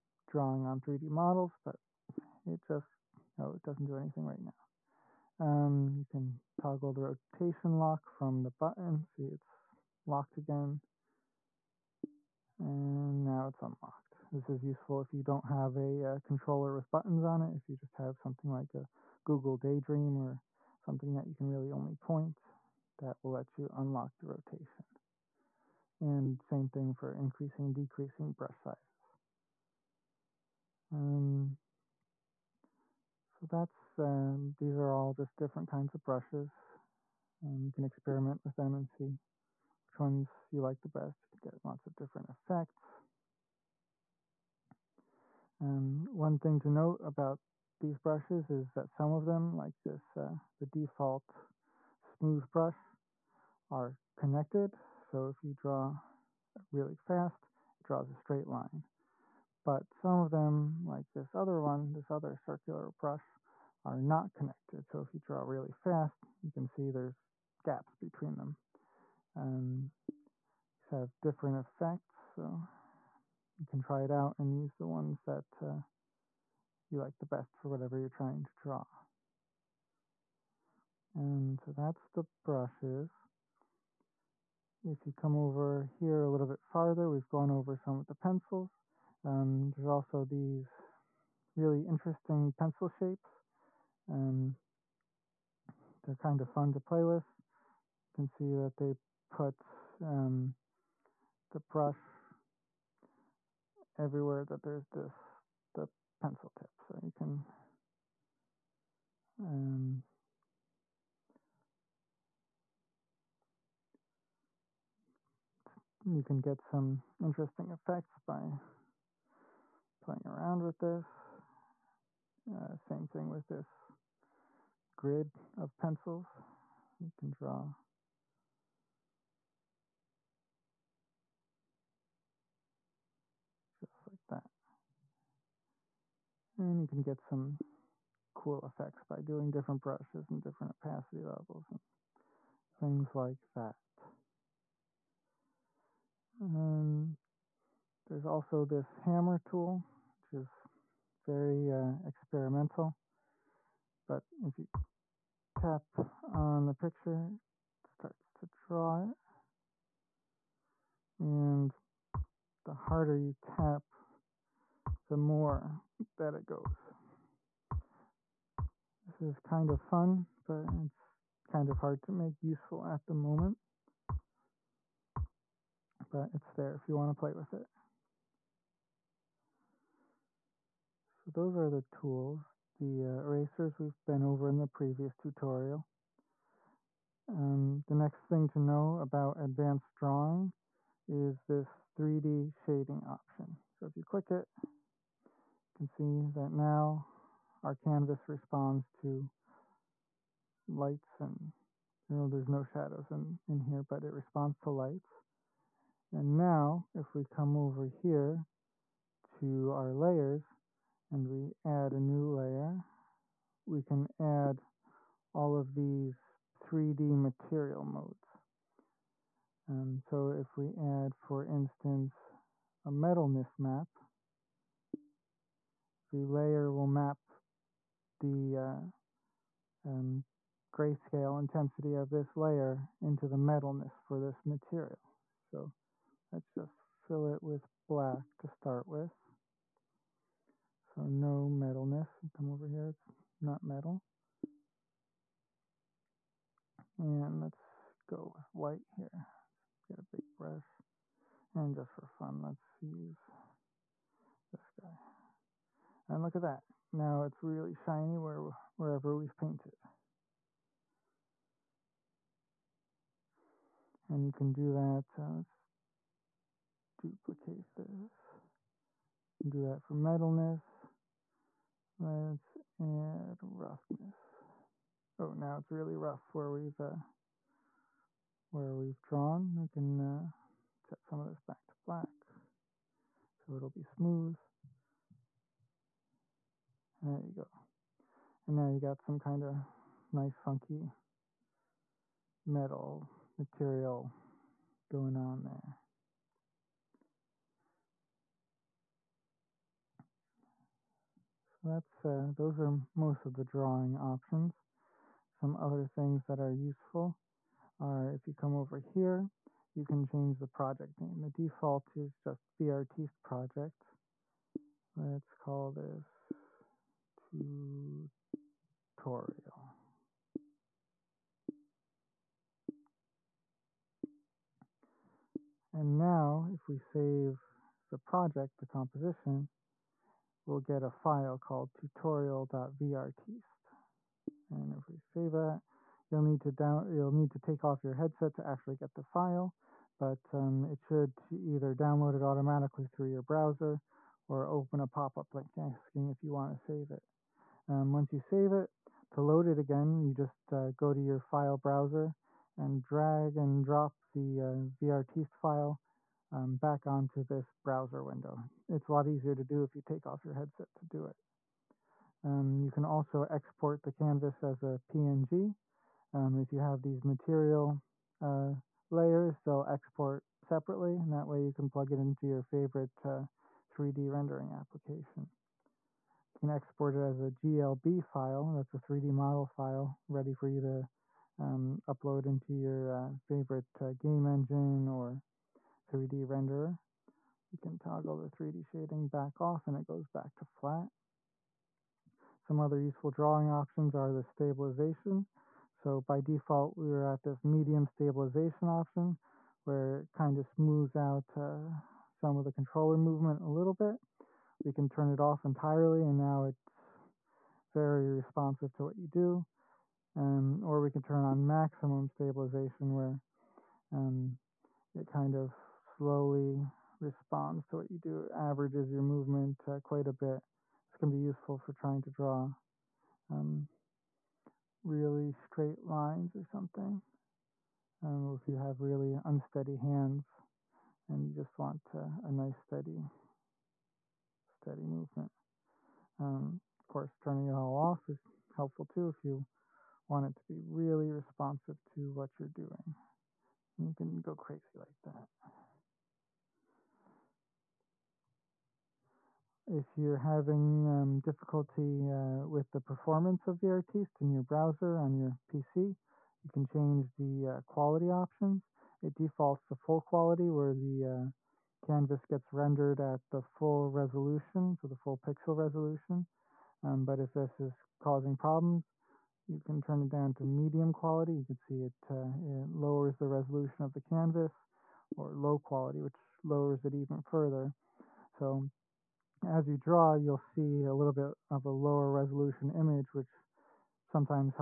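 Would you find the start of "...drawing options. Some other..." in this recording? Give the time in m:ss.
5:03.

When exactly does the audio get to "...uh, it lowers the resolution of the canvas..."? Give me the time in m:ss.
7:52.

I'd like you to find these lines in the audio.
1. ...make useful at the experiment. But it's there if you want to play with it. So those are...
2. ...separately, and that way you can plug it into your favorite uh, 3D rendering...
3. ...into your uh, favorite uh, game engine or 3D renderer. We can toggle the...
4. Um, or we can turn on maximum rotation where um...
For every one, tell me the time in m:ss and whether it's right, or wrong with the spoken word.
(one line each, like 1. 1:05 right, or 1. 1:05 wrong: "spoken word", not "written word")
1. 2:52 wrong: "moment", not "experiment"
2. 6:10 right
3. 6:22 right
4. 6:50 wrong: "stabilization", not "rotation".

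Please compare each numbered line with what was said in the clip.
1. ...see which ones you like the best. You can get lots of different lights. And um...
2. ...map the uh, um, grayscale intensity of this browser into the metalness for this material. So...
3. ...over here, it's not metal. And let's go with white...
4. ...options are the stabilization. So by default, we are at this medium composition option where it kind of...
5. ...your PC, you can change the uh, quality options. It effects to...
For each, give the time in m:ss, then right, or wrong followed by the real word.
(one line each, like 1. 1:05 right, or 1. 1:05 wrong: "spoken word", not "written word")
1. 0:38 wrong: "effects", not "lights"
2. 3:46 wrong: "layer", not "browser"
3. 4:02 right
4. 6:33 wrong: "stabilization", not "composition"
5. 7:35 wrong: "defaults", not "effects".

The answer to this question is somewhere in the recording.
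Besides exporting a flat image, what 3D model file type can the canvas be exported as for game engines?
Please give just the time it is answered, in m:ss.
6:17.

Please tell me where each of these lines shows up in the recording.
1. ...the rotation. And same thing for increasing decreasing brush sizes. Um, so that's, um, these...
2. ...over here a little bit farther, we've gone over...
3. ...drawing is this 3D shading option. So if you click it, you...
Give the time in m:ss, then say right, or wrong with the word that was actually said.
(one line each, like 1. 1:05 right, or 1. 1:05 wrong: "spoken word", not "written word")
1. 0:24 right
2. 1:25 right
3. 3:09 right.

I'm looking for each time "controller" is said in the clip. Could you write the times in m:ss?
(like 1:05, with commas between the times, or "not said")
0:16, 6:42.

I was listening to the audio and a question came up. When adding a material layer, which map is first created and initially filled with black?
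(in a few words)
metalness map.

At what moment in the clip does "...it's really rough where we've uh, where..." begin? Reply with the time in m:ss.
4:35.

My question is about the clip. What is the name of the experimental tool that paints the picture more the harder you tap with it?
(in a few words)
hammer tool.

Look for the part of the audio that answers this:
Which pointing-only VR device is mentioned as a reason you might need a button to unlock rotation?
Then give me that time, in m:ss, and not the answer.
0:19.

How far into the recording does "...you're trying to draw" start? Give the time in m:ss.
1:17.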